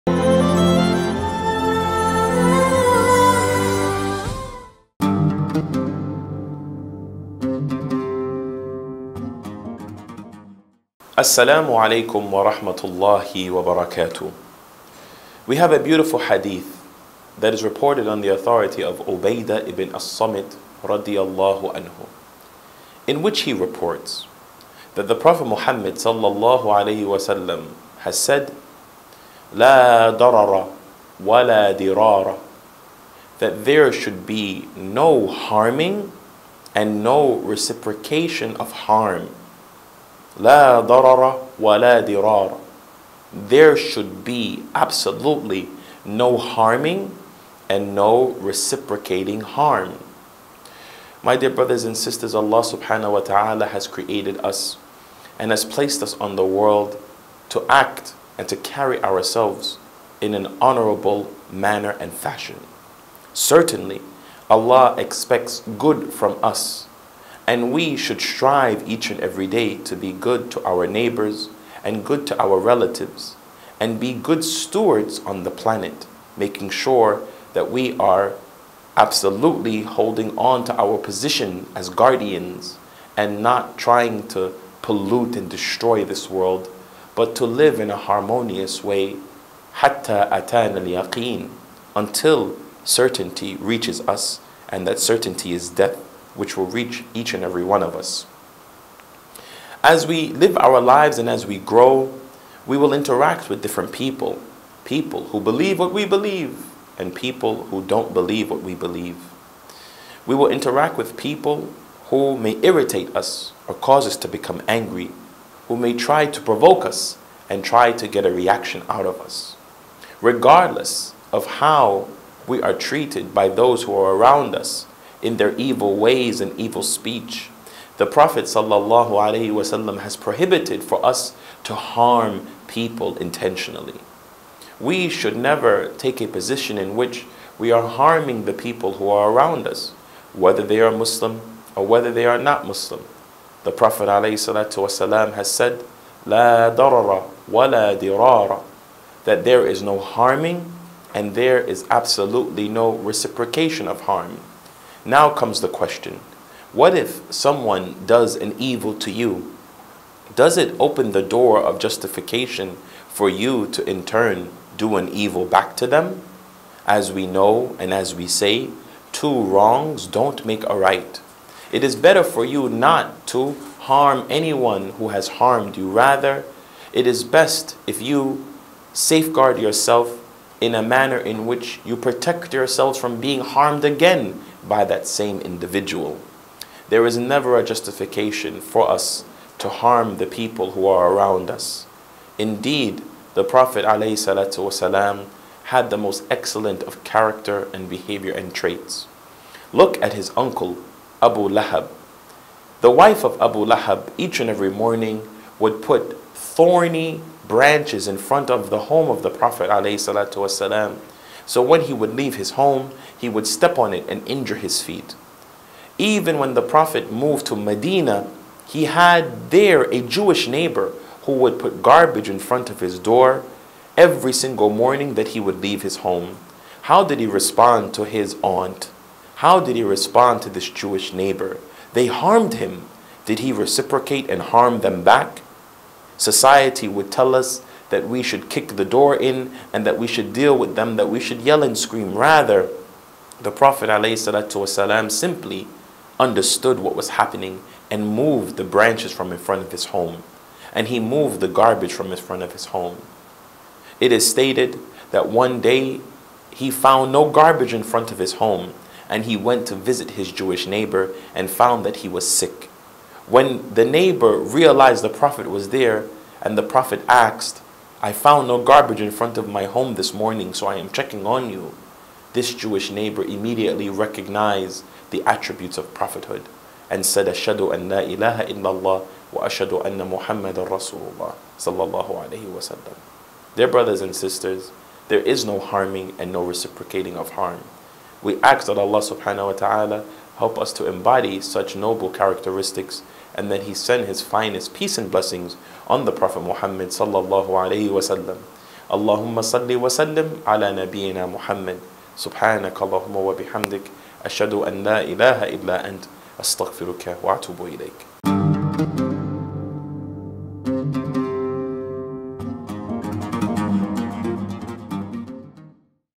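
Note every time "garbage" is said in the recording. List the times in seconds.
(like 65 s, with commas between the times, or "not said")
221 s, 251 s, 257 s, 268 s.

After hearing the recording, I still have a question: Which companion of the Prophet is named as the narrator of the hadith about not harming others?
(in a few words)
Ubadah ibn as-Samit.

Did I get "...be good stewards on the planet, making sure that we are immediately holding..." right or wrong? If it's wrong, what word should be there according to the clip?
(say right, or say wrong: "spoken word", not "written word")
wrong: "absolutely", not "immediately".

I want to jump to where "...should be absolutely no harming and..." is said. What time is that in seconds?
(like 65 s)
43 s.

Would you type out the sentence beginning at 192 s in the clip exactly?
Indeed, the Prophet ﷺ had the most excellent of character and behavior and traits.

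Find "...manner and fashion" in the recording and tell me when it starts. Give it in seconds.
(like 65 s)
61 s.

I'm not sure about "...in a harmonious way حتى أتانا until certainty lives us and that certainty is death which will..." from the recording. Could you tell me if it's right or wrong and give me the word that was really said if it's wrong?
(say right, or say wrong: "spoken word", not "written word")
wrong: "reaches", not "lives".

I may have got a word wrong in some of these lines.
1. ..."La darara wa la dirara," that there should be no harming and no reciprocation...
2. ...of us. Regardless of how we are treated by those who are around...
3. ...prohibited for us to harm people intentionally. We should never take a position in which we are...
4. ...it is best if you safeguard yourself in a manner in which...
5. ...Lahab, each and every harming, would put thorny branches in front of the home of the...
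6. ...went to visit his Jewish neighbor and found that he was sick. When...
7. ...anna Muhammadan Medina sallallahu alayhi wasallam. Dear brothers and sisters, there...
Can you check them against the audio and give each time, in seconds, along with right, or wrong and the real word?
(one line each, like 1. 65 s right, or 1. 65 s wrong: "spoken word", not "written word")
1. 29 s right
2. 119 s right
3. 130 s right
4. 176 s right
5. 203 s wrong: "morning", not "harming"
6. 259 s right
7. 279 s wrong: "Rasulullah", not "Medina".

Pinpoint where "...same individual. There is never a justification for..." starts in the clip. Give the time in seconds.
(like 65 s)
185 s.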